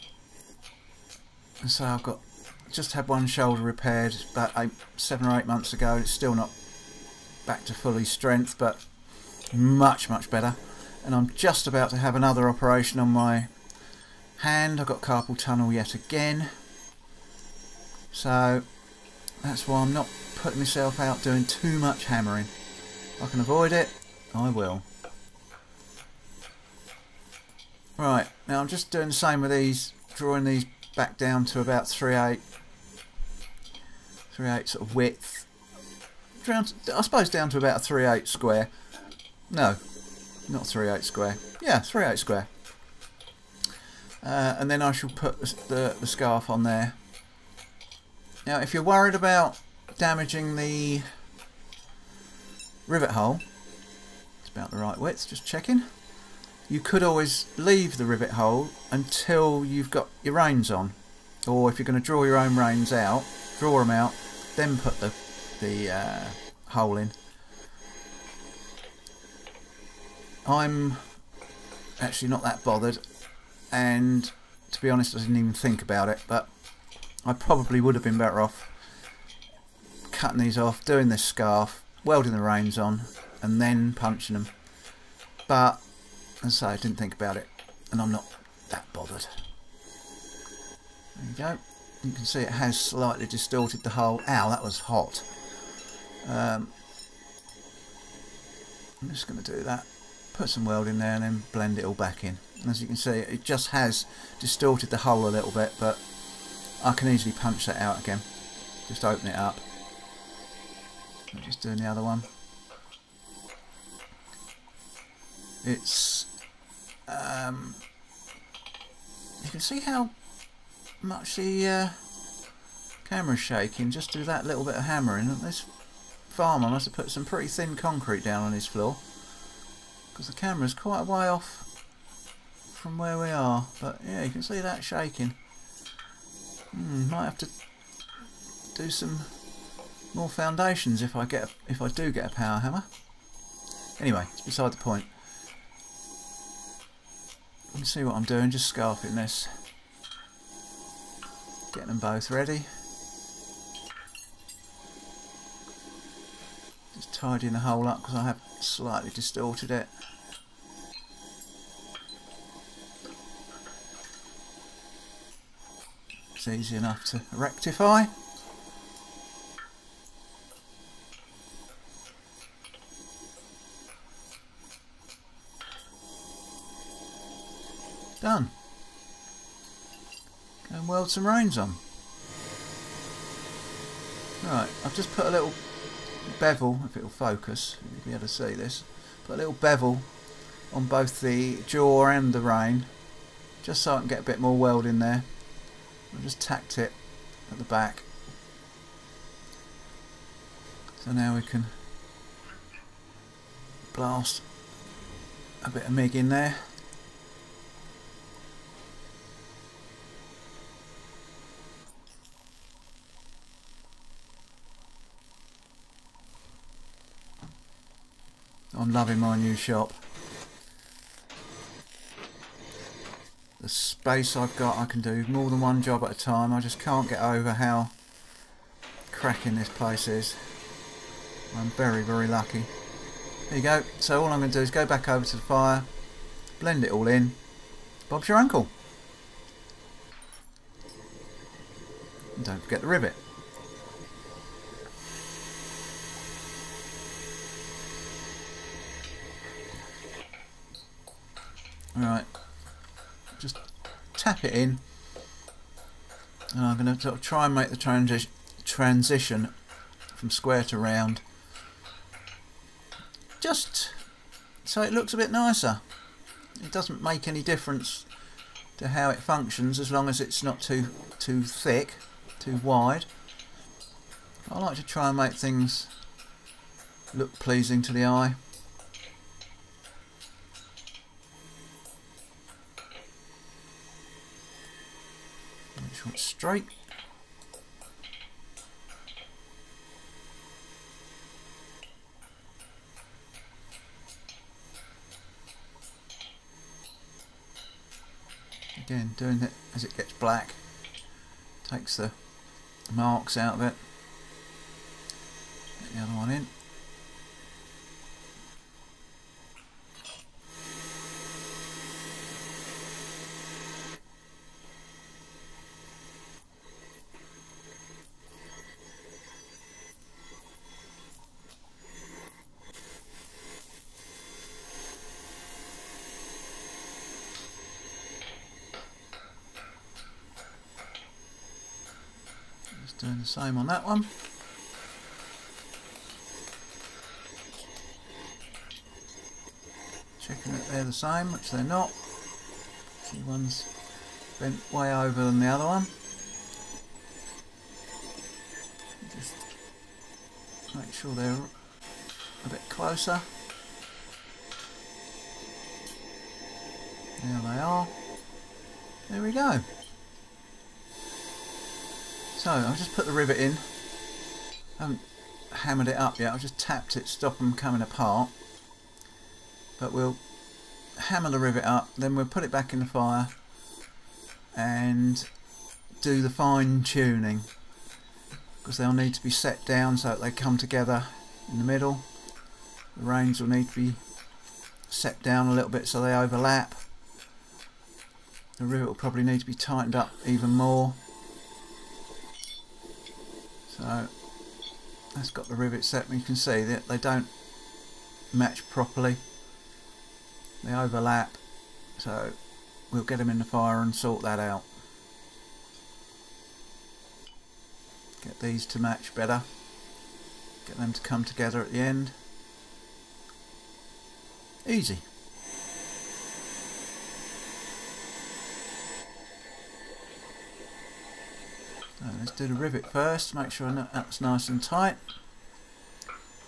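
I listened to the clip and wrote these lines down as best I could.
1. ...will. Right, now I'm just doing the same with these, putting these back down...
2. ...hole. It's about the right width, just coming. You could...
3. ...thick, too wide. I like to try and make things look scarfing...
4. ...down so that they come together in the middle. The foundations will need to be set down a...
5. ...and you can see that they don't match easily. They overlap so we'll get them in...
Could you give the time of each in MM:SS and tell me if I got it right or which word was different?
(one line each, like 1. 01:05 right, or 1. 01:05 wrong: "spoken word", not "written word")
1. 00:24 wrong: "drawing", not "putting"
2. 00:53 wrong: "checking", not "coming"
3. 04:31 wrong: "pleasing", not "scarfing"
4. 06:19 wrong: "reins", not "foundations"
5. 06:36 wrong: "properly", not "easily".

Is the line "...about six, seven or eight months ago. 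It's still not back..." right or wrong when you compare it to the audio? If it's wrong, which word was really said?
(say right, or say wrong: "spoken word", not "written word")
wrong: "eight", not "six".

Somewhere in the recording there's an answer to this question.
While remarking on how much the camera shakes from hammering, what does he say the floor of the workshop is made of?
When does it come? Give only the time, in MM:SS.
02:07.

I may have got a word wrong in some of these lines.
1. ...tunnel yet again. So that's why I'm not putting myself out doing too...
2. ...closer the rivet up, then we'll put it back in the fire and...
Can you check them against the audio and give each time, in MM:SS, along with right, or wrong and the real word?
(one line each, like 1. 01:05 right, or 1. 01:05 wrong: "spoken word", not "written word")
1. 00:15 right
2. 06:11 wrong: "hammer", not "closer".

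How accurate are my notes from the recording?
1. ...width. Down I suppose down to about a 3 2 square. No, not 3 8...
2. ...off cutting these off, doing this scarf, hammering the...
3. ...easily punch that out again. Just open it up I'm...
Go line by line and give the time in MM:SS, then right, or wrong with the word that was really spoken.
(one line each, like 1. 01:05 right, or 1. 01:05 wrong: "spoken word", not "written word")
1. 00:34 wrong: "8", not "2"
2. 01:18 wrong: "welding", not "hammering"
3. 01:47 right.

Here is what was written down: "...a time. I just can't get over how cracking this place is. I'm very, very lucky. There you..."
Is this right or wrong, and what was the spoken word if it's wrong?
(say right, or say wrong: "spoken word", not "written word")
right.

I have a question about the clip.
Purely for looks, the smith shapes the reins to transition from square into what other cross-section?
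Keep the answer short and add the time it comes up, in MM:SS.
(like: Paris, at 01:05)
Round, at 04:20.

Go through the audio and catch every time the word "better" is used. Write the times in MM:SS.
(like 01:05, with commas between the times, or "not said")
00:10, 01:18, 06:49.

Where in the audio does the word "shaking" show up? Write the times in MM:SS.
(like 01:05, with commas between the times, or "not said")
02:03, 02:14.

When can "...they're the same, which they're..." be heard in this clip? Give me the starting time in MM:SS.
05:40.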